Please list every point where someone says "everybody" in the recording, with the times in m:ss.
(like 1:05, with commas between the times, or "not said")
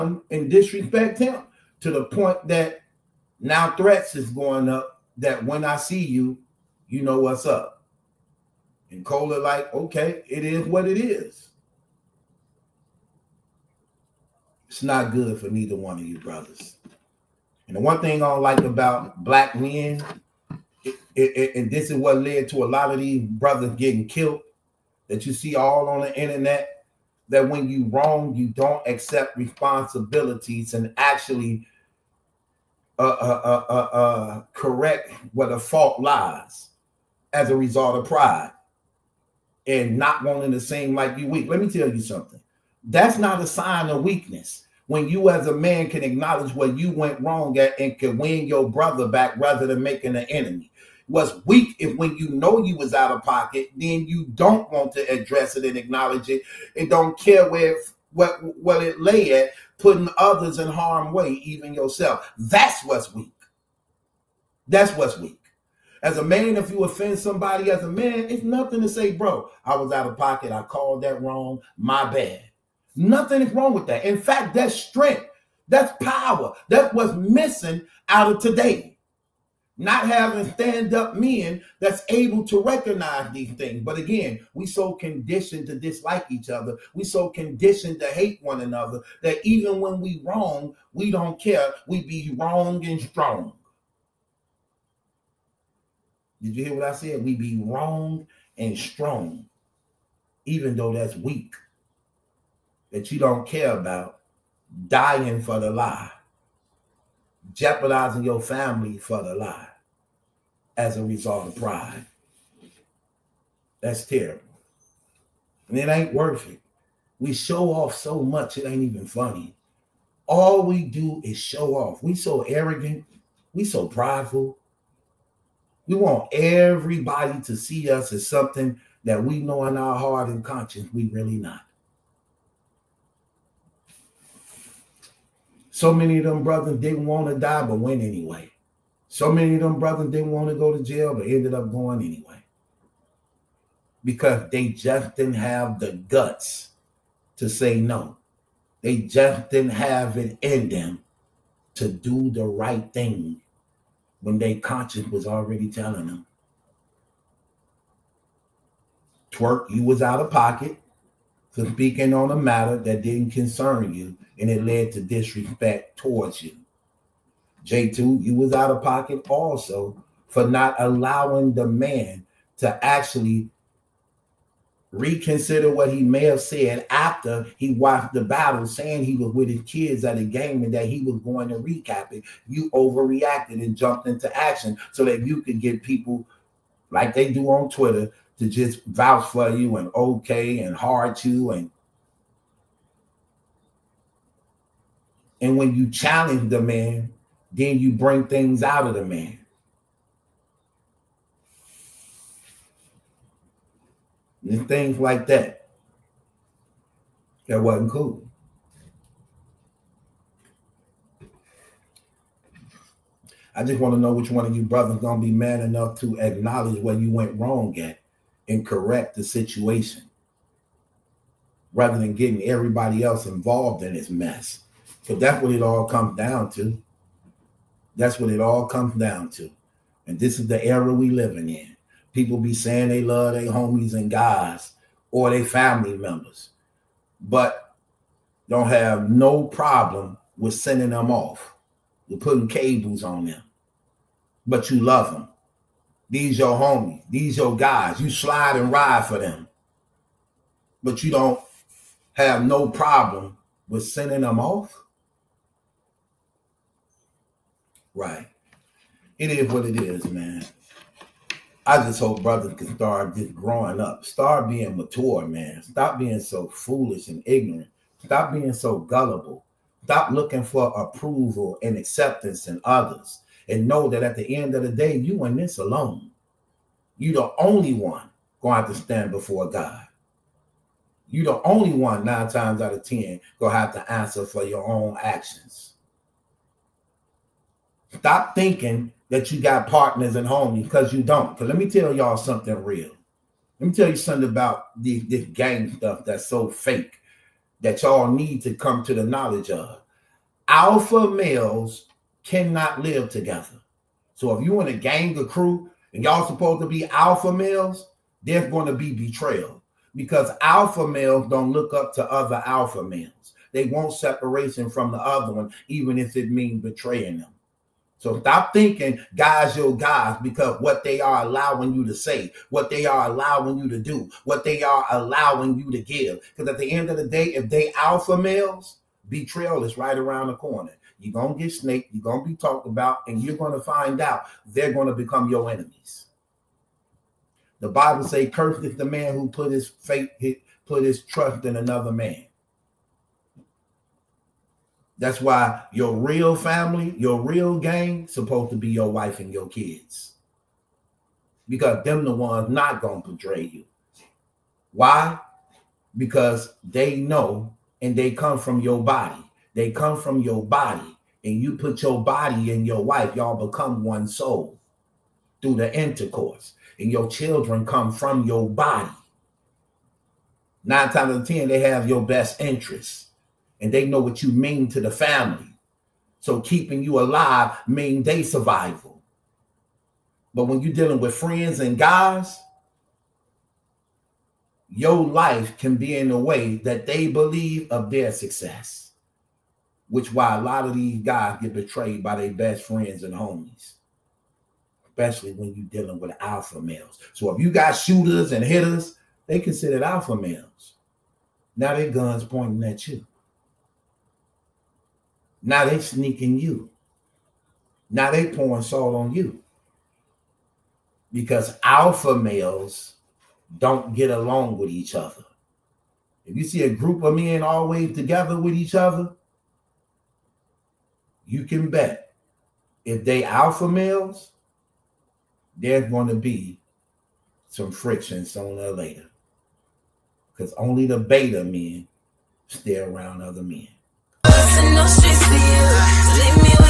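2:06, 3:42.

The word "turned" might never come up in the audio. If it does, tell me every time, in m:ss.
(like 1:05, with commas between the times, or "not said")
not said.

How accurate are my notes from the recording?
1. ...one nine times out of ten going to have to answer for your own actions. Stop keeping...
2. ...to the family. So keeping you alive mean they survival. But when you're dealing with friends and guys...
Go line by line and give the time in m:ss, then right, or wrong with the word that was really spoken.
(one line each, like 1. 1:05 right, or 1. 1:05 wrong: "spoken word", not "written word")
1. 4:41 wrong: "thinking", not "keeping"
2. 6:14 right.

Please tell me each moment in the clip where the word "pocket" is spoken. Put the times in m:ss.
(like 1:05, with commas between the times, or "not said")
0:53, 1:10, 2:40, 2:48.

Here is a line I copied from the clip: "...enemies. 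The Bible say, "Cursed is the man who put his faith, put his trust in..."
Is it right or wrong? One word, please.
right.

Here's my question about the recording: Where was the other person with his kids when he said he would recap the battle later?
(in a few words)
at a game.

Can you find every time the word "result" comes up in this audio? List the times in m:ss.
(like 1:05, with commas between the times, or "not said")
0:37, 1:51.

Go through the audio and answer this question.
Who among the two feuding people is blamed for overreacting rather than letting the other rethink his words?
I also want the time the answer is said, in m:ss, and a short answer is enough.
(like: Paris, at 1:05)
J2, at 2:47.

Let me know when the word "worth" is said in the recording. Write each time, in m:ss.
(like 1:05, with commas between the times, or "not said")
1:56.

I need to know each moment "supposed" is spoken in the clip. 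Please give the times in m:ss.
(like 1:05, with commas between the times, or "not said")
5:06, 5:48.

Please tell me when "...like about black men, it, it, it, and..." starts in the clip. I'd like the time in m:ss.
0:18.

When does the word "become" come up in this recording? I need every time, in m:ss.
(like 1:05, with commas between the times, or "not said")
5:34, 6:03.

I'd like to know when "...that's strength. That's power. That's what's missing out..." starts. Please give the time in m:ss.
1:14.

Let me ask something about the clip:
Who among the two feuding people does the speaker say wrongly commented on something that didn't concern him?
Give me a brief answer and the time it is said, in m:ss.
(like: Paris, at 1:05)
Twork, at 2:39.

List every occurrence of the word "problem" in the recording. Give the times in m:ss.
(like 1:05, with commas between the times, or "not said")
3:59, 4:12.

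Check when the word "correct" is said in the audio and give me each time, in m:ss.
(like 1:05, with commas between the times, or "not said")
0:34, 3:38.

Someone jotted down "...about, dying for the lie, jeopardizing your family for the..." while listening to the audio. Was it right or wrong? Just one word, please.
right.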